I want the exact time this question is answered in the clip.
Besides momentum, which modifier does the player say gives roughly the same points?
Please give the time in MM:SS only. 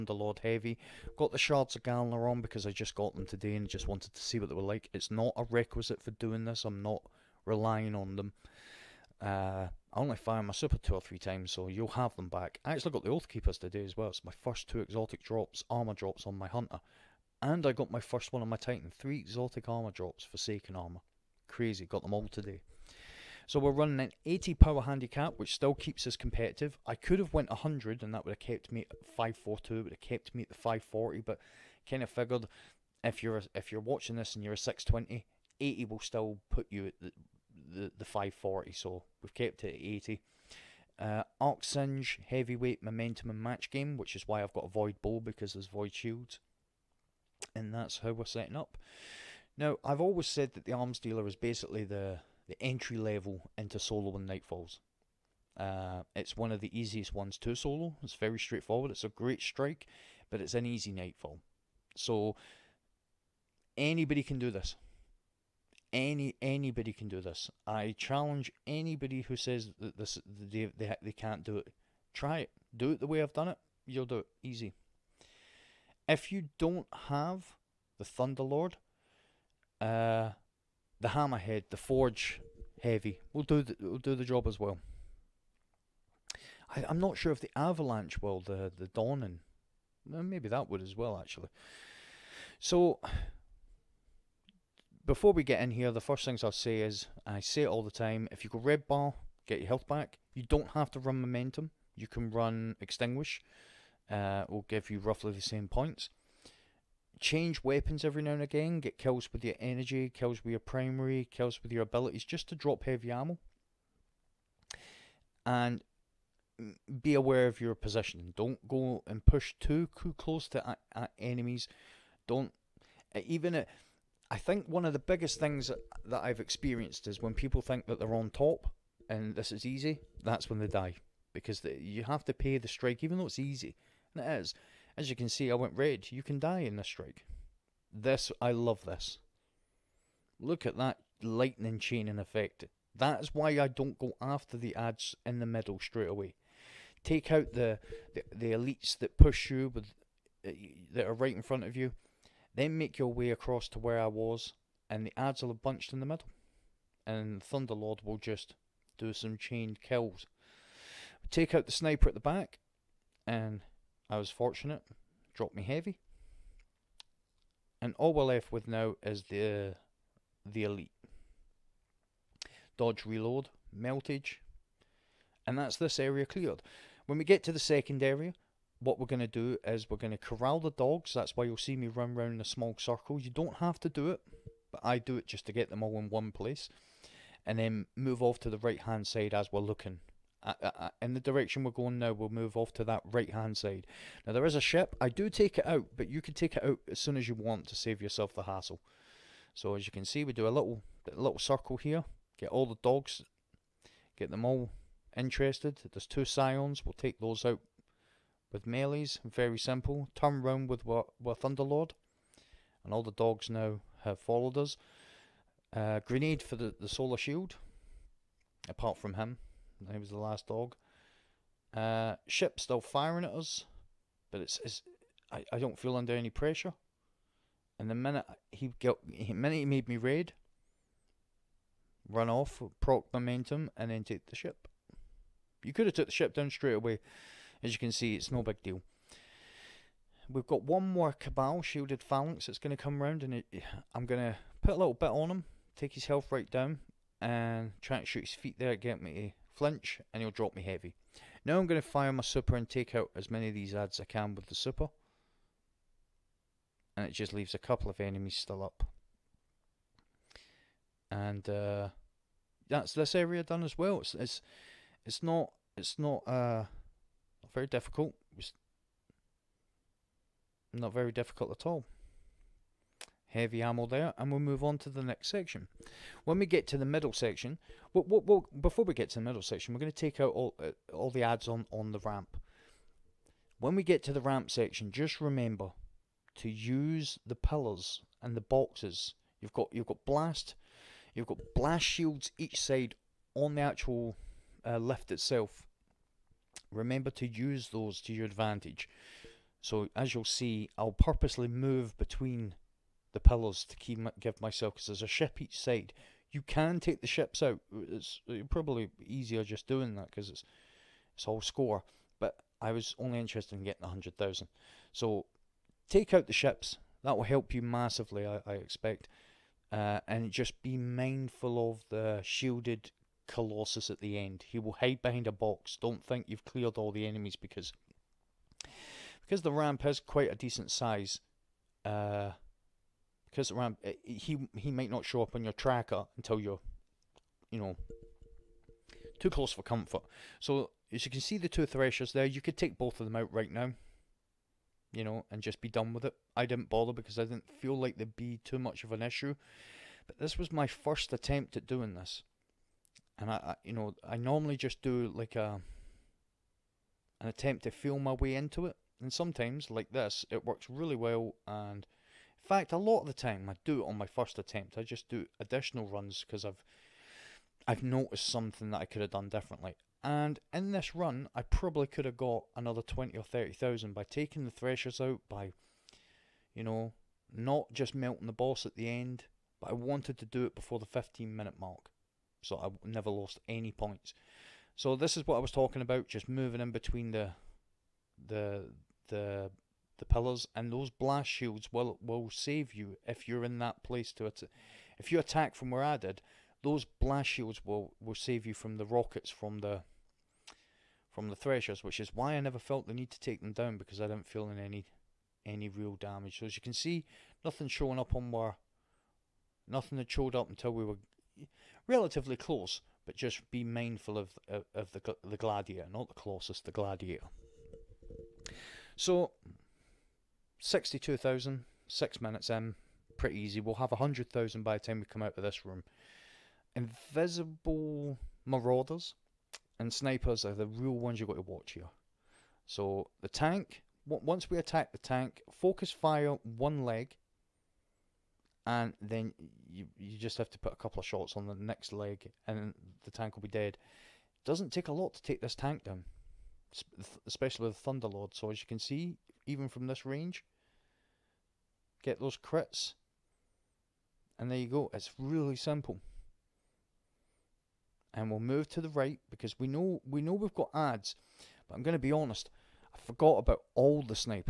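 01:42.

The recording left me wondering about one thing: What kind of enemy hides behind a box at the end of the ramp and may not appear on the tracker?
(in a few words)
shielded Colossus.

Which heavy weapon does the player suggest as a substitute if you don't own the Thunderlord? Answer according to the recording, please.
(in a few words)
Hammerhead.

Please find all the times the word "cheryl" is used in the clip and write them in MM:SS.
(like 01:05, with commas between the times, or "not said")
not said.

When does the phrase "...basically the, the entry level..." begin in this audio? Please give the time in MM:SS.
00:51.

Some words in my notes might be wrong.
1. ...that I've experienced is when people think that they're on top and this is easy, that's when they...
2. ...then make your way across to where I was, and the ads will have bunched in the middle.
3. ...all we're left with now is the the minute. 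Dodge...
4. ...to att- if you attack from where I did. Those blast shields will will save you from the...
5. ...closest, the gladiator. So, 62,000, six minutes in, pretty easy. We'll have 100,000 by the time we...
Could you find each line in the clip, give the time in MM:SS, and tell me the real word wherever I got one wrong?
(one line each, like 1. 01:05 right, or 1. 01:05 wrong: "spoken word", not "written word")
1. 02:06 right
2. 02:32 right
3. 02:47 wrong: "elite", not "minute"
4. 06:34 right
5. 06:56 right.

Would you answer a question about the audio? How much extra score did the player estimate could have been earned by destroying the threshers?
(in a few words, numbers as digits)
20 or 30,000.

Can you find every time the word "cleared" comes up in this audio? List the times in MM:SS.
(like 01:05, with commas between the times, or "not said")
02:56, 05:26.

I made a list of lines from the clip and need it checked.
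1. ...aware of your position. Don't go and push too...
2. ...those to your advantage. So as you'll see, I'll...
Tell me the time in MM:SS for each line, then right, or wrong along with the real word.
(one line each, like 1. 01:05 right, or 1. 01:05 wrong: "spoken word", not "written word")
1. 01:57 right
2. 04:57 right.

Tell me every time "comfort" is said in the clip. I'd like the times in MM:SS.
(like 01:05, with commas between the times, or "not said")
05:39.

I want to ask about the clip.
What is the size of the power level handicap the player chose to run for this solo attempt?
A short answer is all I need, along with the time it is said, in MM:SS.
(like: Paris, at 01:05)
80, at 00:24.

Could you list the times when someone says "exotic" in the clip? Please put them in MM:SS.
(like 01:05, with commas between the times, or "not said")
00:14, 00:19.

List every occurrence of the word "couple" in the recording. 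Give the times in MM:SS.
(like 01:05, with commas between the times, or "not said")
04:17, 07:20.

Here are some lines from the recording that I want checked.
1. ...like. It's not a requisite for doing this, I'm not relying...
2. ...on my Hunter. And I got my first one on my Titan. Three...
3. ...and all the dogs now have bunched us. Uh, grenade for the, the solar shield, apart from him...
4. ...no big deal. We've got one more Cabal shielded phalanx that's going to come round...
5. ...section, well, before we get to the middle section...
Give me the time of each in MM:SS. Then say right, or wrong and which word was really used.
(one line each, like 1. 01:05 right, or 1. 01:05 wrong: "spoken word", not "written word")
1. 00:04 right
2. 00:16 right
3. 03:32 wrong: "followed", not "bunched"
4. 03:58 right
5. 04:37 right.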